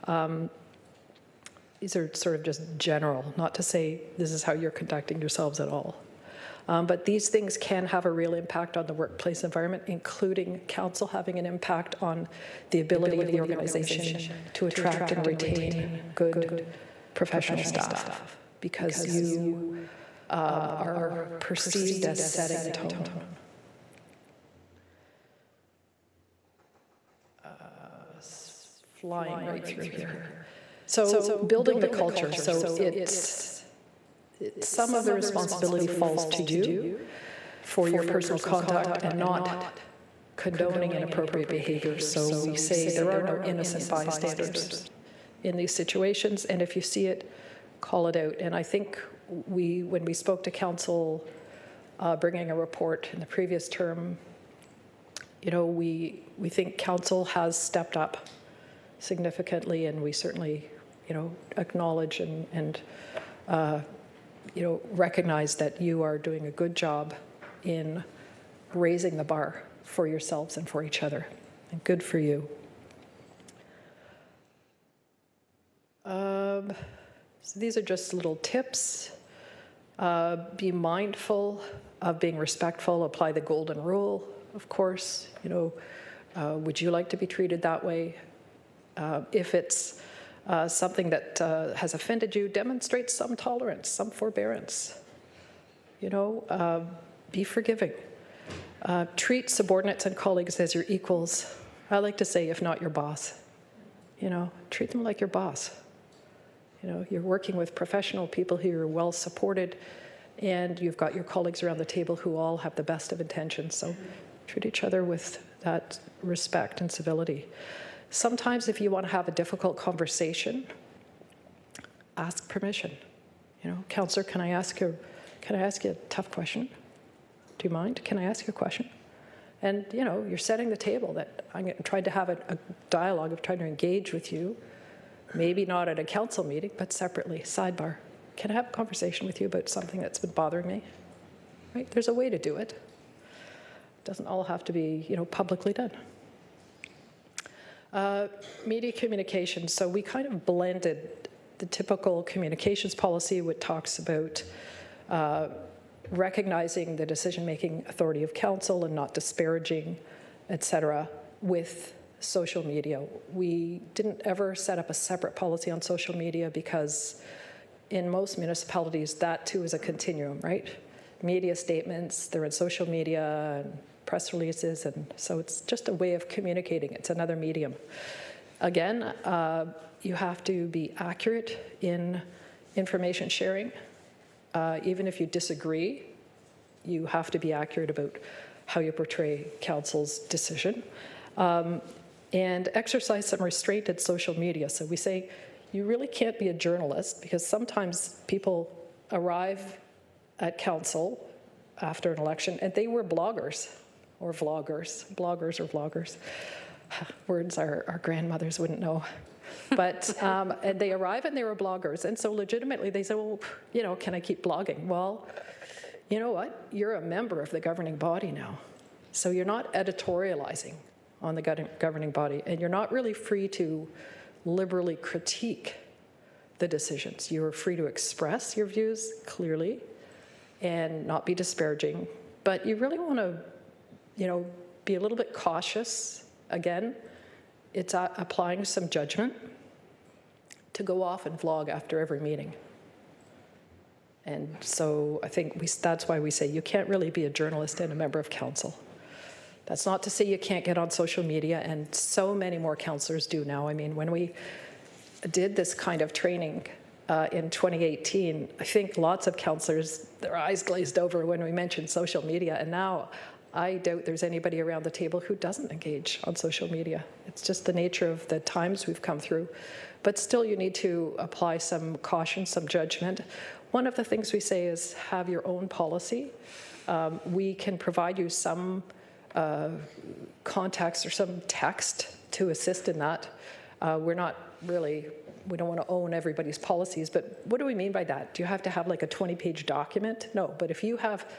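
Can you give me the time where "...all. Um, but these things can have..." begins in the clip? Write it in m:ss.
0:05.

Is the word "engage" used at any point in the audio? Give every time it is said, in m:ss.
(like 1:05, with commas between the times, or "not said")
2:13, 4:25.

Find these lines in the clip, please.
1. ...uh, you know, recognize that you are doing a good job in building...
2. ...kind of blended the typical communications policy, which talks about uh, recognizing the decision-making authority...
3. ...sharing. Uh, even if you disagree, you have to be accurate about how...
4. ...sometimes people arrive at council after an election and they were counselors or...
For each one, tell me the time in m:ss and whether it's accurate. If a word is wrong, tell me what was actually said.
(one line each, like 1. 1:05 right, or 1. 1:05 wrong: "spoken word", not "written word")
1. 1:03 wrong: "raising", not "building"
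2. 2:30 right
3. 3:03 right
4. 3:17 wrong: "bloggers", not "counselors".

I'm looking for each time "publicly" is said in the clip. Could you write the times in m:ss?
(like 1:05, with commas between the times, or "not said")
2:25.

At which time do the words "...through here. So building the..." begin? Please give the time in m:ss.
0:29.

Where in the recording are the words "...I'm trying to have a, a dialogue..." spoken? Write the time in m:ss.
2:11.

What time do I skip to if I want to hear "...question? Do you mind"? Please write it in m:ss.
2:06.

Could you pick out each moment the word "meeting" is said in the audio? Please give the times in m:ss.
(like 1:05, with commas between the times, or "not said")
2:16, 4:02.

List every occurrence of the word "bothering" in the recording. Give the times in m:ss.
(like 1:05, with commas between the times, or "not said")
2:20.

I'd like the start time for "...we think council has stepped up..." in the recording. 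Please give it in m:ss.
0:56.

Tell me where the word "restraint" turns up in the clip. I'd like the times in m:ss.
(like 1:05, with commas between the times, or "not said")
3:13.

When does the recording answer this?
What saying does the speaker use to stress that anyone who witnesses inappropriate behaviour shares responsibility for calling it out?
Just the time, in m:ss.
0:43.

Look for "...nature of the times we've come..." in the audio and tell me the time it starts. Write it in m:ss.
4:27.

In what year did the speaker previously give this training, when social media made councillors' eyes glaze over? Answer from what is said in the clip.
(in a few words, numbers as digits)
2018.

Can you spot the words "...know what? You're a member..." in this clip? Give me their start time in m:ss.
3:36.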